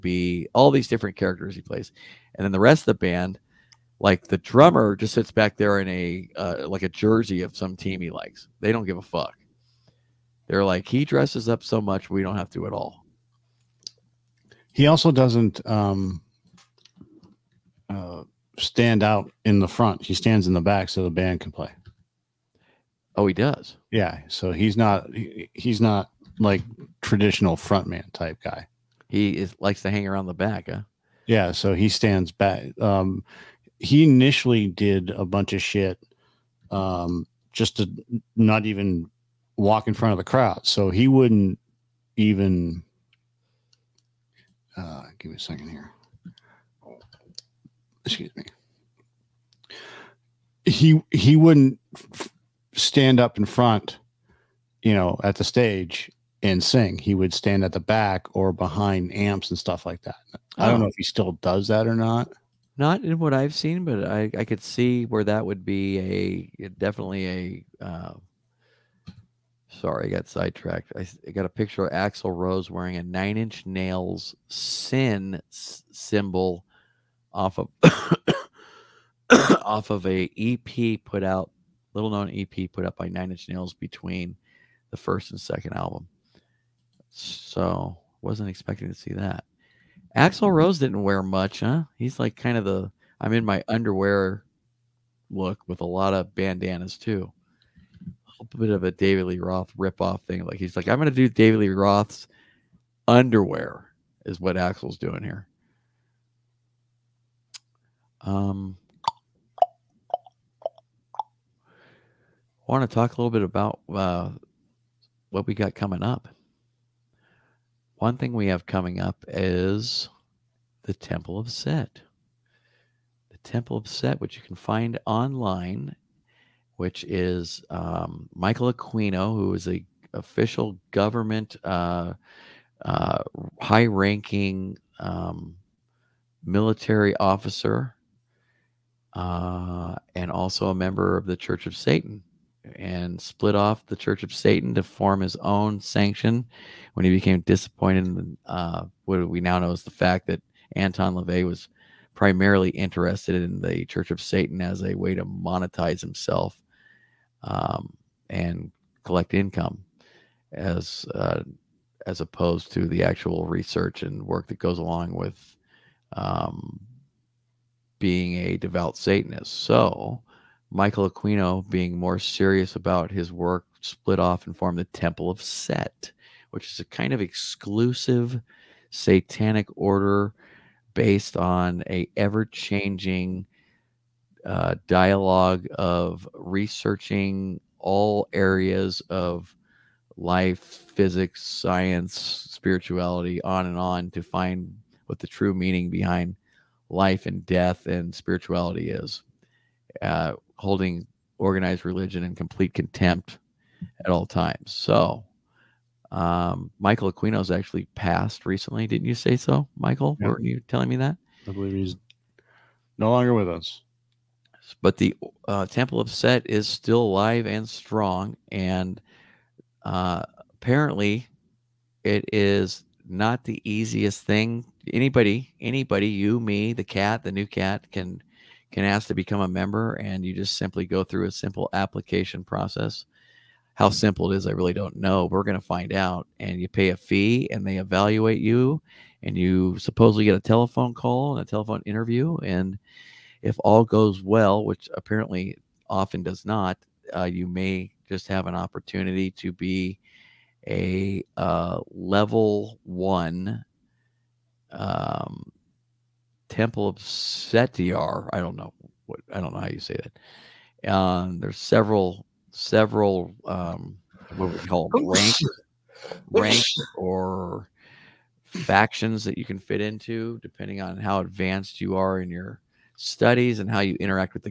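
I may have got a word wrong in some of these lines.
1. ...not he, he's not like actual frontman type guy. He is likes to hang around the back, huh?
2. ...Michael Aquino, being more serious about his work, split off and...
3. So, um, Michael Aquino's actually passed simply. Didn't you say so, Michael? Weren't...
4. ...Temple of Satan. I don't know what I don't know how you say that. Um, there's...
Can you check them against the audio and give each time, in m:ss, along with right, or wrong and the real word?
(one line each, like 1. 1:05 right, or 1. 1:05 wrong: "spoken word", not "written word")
1. 0:24 wrong: "traditional", not "actual"
2. 2:50 right
3. 3:24 wrong: "recently", not "simply"
4. 4:16 wrong: "Setiar", not "Satan".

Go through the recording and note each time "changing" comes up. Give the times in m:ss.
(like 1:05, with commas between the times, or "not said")
3:02.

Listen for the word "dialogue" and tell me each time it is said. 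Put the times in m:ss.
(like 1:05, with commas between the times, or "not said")
3:04.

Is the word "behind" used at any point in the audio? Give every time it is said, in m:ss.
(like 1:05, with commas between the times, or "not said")
0:58, 3:15.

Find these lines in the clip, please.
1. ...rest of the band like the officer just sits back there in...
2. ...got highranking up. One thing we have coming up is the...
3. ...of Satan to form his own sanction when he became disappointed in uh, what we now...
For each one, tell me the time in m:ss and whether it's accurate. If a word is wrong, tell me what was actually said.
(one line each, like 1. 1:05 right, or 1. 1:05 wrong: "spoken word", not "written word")
1. 0:02 wrong: "drummer", not "officer"
2. 1:55 wrong: "coming", not "highranking"
3. 2:24 right.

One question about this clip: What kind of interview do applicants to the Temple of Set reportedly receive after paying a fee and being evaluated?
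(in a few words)
A telephone interview.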